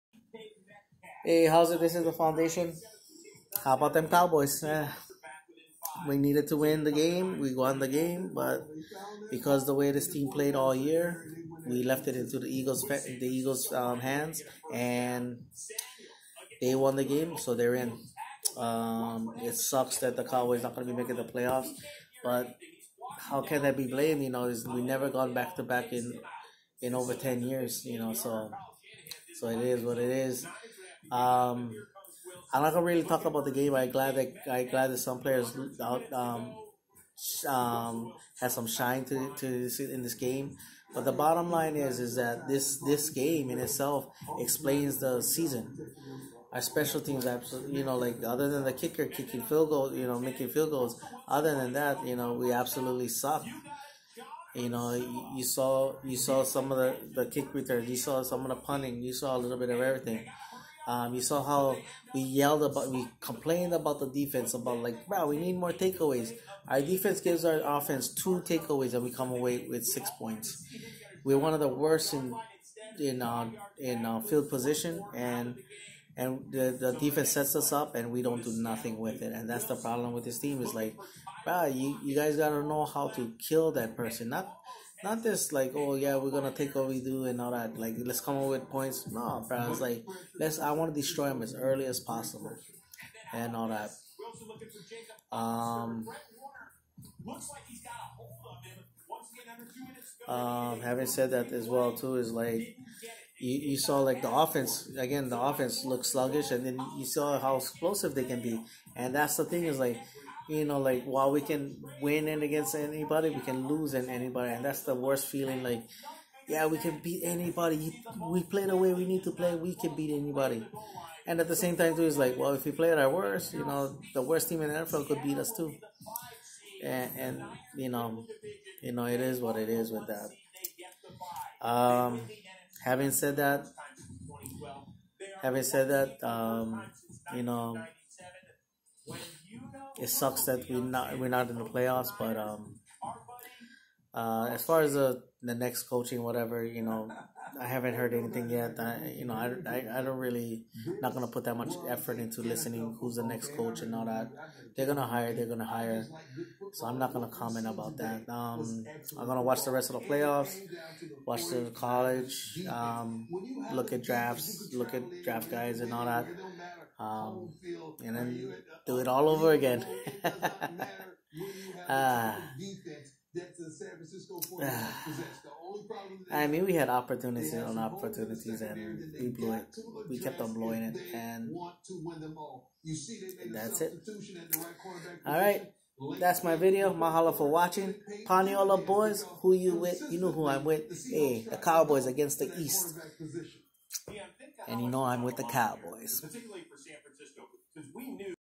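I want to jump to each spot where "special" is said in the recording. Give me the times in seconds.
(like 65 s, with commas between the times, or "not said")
46 s.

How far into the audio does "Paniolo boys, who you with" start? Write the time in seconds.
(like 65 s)
188 s.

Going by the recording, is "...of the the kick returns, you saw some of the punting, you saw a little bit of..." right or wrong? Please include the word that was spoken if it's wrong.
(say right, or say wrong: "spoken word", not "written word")
right.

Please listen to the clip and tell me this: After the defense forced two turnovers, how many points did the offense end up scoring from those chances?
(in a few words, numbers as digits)
6.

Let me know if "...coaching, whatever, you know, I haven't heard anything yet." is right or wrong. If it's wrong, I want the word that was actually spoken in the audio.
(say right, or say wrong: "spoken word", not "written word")
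right.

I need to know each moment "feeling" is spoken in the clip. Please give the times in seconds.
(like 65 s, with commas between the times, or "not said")
115 s.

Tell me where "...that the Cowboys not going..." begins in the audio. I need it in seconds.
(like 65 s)
19 s.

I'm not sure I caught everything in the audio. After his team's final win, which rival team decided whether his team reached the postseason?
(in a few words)
Eagles.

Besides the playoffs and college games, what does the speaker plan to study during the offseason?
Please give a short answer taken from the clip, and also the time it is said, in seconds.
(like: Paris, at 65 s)
draft guys, at 165 s.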